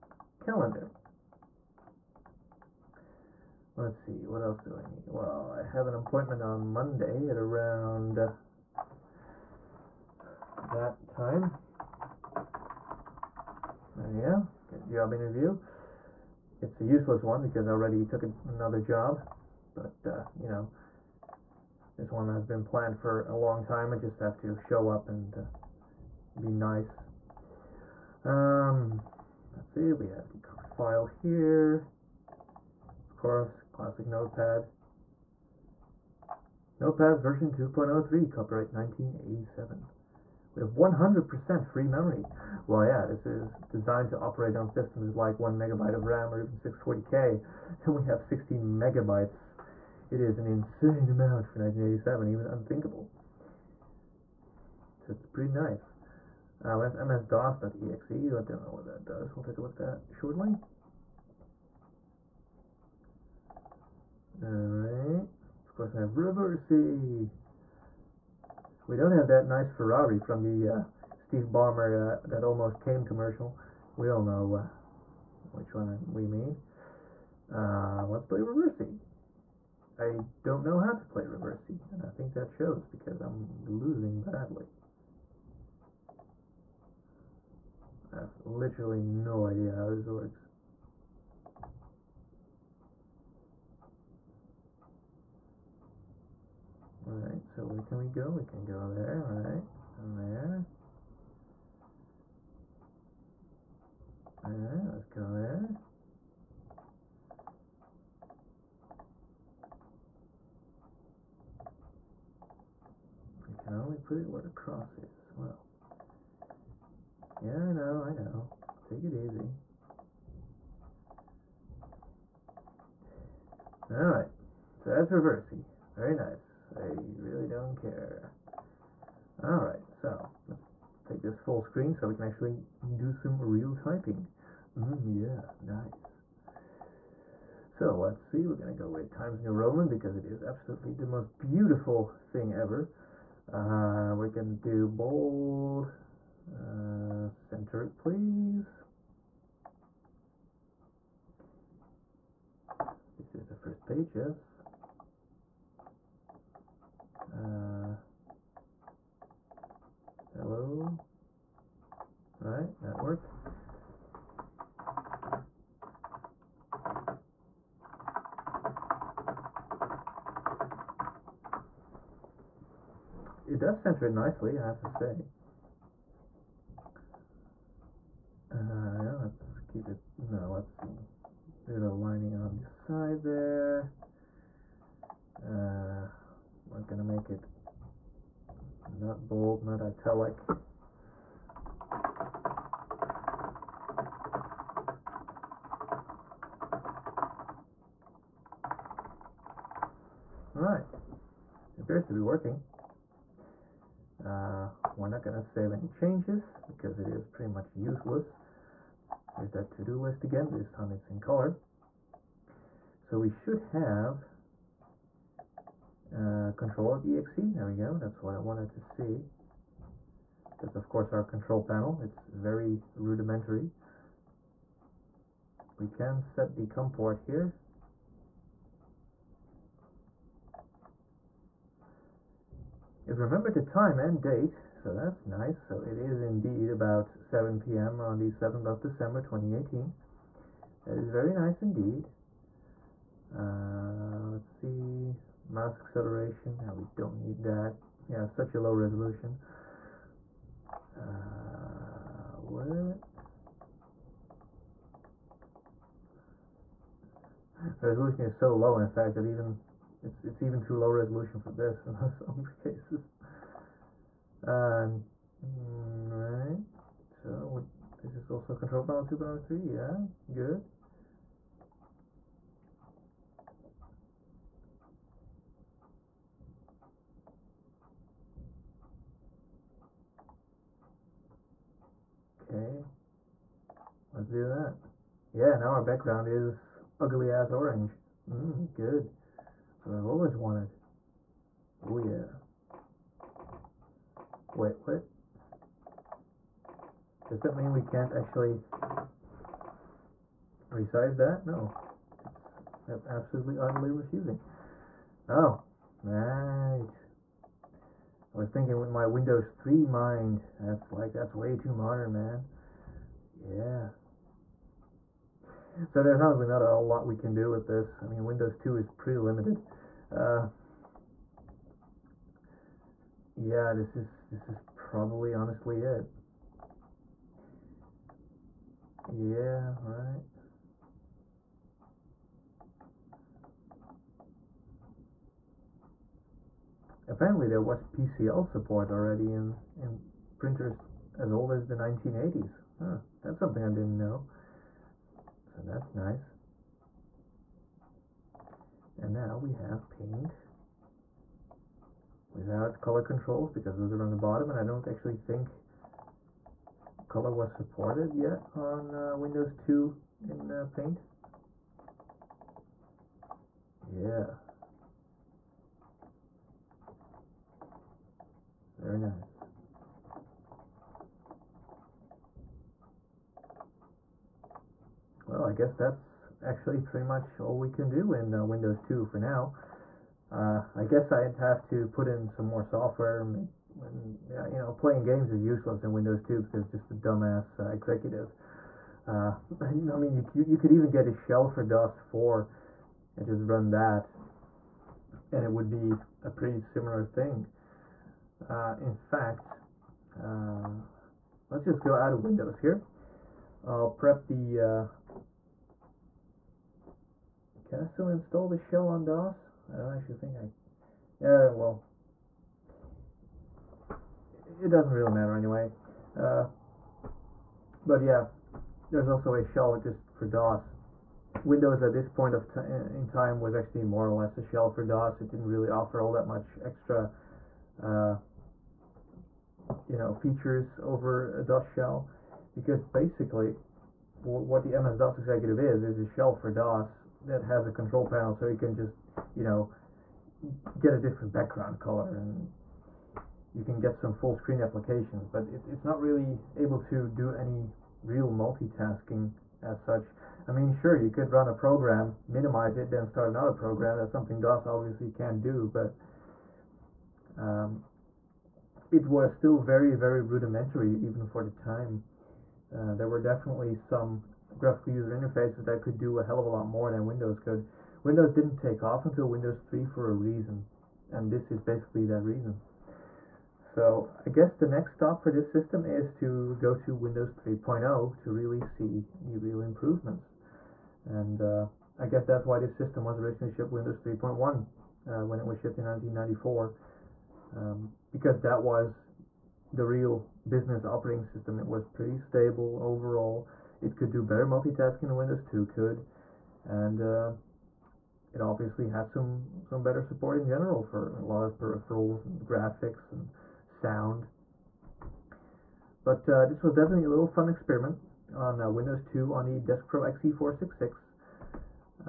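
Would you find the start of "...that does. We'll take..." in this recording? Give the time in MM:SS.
00:58.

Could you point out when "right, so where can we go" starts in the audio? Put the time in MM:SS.
01:37.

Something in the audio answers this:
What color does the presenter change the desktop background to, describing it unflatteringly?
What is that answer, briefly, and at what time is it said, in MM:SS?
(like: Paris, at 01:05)
Orange, at 04:47.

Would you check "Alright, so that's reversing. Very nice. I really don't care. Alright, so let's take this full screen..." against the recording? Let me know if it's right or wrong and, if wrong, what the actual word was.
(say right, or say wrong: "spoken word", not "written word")
right.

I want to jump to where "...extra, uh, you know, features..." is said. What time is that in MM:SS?
07:06.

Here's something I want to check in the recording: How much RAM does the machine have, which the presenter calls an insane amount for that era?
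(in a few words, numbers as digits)
16 megabytes.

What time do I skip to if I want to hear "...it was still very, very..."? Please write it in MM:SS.
07:38.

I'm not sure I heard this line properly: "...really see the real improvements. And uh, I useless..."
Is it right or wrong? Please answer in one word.
wrong.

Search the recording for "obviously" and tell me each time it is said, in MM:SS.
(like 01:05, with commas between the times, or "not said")
07:34, 08:18.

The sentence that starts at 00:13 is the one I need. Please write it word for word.
There you go, good job interview.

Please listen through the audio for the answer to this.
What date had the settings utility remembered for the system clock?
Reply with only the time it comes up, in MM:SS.
03:58.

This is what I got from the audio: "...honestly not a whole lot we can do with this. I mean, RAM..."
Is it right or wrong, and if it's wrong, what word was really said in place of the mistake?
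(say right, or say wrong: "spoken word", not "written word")
wrong: "Windows", not "RAM".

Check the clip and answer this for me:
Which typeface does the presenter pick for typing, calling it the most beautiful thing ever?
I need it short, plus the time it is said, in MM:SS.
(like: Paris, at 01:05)
Times New Roman, at 02:19.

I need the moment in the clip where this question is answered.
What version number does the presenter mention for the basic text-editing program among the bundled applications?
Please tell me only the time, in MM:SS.
00:36.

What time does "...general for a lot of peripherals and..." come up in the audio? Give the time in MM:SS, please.
08:20.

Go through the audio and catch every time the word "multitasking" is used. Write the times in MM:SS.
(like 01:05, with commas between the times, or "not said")
07:28, 08:14.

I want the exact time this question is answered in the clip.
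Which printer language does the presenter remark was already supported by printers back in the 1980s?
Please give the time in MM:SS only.
05:37.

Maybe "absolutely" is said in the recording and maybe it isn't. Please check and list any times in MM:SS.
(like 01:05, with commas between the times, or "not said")
02:20, 05:03.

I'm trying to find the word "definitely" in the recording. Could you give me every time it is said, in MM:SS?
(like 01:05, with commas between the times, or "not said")
07:43, 08:26.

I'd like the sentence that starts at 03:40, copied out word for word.
That's of course our control panel, it's very rudimentary.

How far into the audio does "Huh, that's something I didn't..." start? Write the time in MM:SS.
05:42.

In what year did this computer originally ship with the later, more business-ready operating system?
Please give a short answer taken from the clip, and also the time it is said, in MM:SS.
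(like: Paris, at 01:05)
1994, at 08:05.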